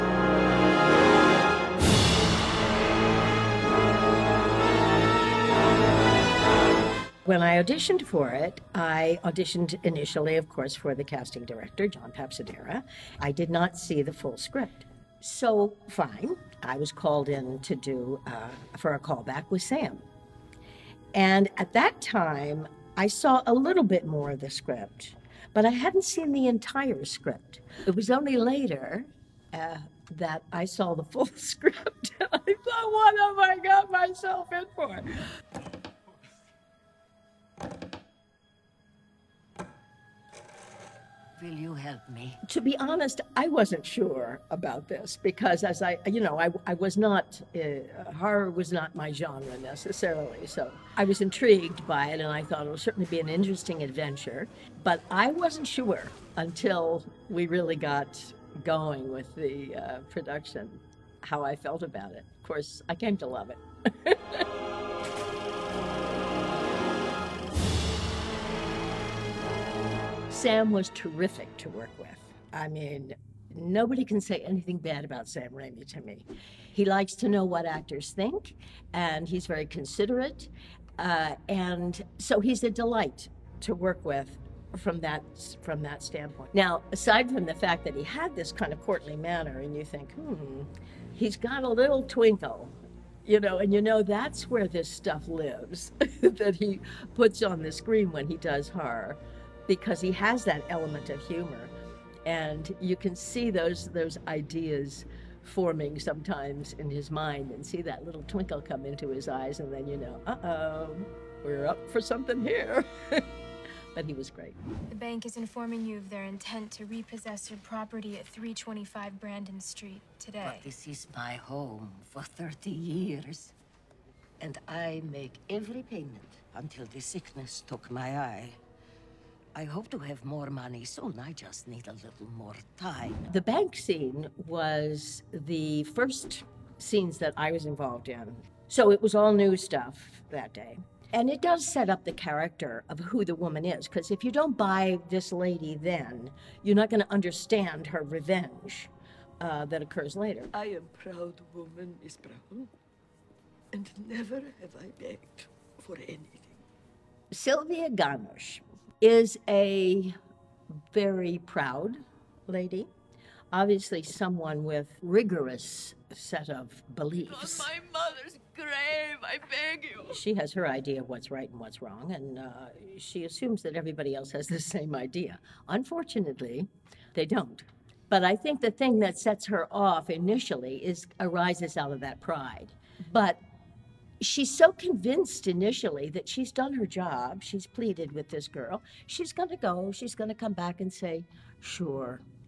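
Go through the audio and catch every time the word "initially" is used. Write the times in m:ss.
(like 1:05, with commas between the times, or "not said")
0:09, 3:00, 3:05.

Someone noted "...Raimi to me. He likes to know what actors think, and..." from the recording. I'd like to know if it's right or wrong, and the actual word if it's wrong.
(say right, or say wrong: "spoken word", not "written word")
right.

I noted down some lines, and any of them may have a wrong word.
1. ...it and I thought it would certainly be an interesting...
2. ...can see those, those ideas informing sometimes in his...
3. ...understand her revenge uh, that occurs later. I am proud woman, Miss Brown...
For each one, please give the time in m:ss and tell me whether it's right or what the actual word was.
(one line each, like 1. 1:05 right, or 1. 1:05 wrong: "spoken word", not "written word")
1. 0:52 right
2. 1:42 wrong: "forming", not "informing"
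3. 2:27 right.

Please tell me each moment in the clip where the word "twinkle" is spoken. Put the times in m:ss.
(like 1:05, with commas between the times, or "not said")
1:32, 1:48.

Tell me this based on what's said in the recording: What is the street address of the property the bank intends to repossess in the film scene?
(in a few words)
325 Brandon Street.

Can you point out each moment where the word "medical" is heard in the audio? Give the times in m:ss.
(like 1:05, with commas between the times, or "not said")
not said.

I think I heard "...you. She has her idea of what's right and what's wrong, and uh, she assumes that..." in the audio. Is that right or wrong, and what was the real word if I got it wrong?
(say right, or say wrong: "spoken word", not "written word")
right.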